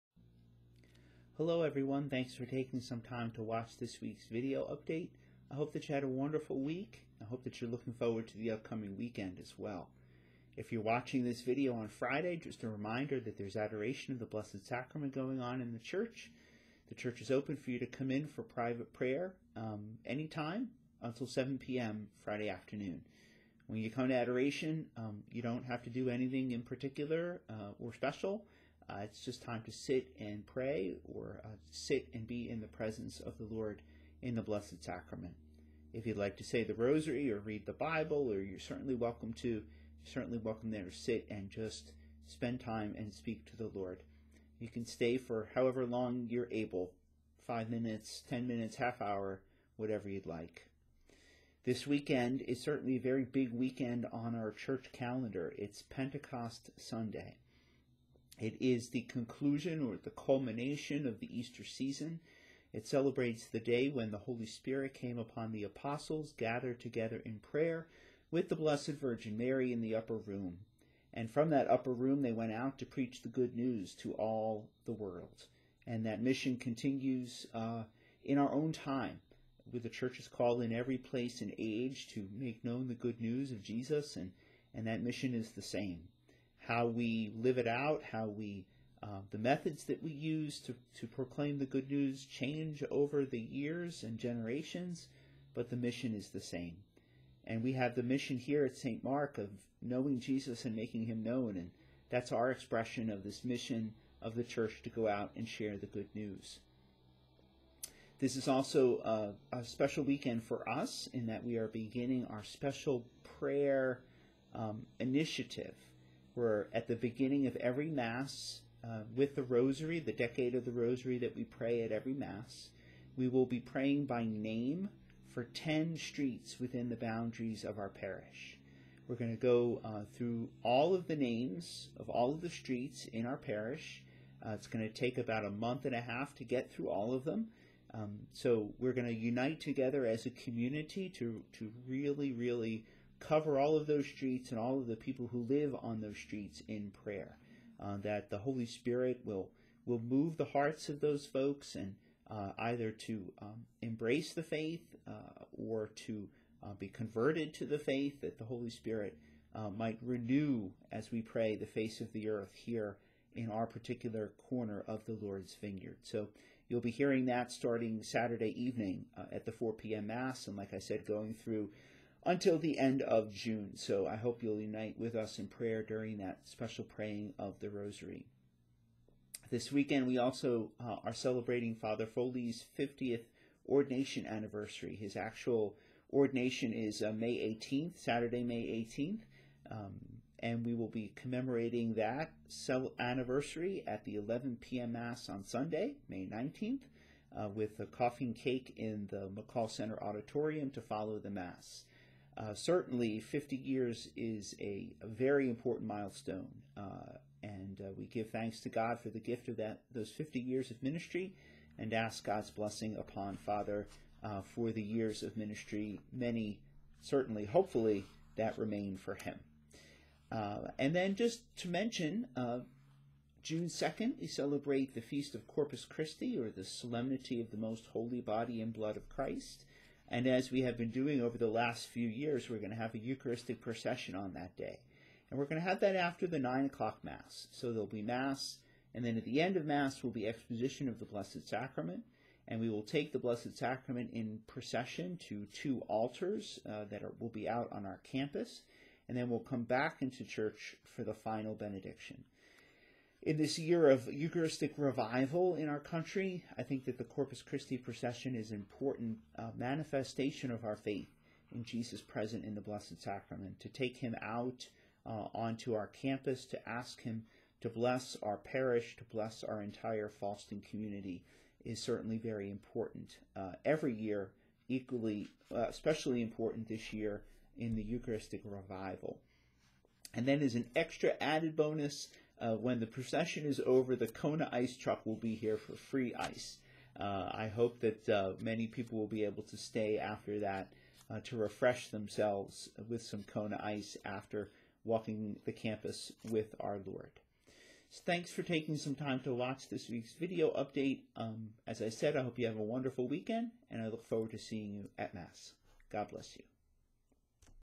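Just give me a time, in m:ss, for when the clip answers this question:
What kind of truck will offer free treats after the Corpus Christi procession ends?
4:44.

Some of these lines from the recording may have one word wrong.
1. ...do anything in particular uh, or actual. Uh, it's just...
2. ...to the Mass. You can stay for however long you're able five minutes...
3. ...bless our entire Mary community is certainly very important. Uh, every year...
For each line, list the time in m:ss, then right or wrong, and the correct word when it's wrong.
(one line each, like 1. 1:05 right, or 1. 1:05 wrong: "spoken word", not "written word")
1. 0:25 wrong: "special", not "actual"
2. 0:43 wrong: "Lord", not "Mass"
3. 4:29 wrong: "Fallston", not "Mary".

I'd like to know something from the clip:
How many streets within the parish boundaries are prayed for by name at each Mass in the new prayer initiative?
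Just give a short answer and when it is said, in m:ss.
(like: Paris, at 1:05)
10, at 2:05.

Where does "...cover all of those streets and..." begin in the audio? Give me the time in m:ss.
2:23.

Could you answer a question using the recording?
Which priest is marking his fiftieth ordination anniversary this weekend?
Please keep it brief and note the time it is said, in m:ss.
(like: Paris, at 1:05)
Father Foley, at 3:01.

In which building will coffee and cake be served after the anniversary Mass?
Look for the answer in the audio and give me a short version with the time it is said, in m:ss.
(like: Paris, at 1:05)
McCall Center Auditorium, at 3:19.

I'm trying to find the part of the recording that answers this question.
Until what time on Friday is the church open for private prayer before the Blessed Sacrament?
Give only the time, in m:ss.
0:21.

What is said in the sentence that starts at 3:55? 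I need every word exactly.
And we're going to have that after the 9 o'clock Mass.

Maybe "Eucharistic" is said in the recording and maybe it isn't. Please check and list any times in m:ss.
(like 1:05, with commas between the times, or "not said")
3:52, 4:14, 4:37.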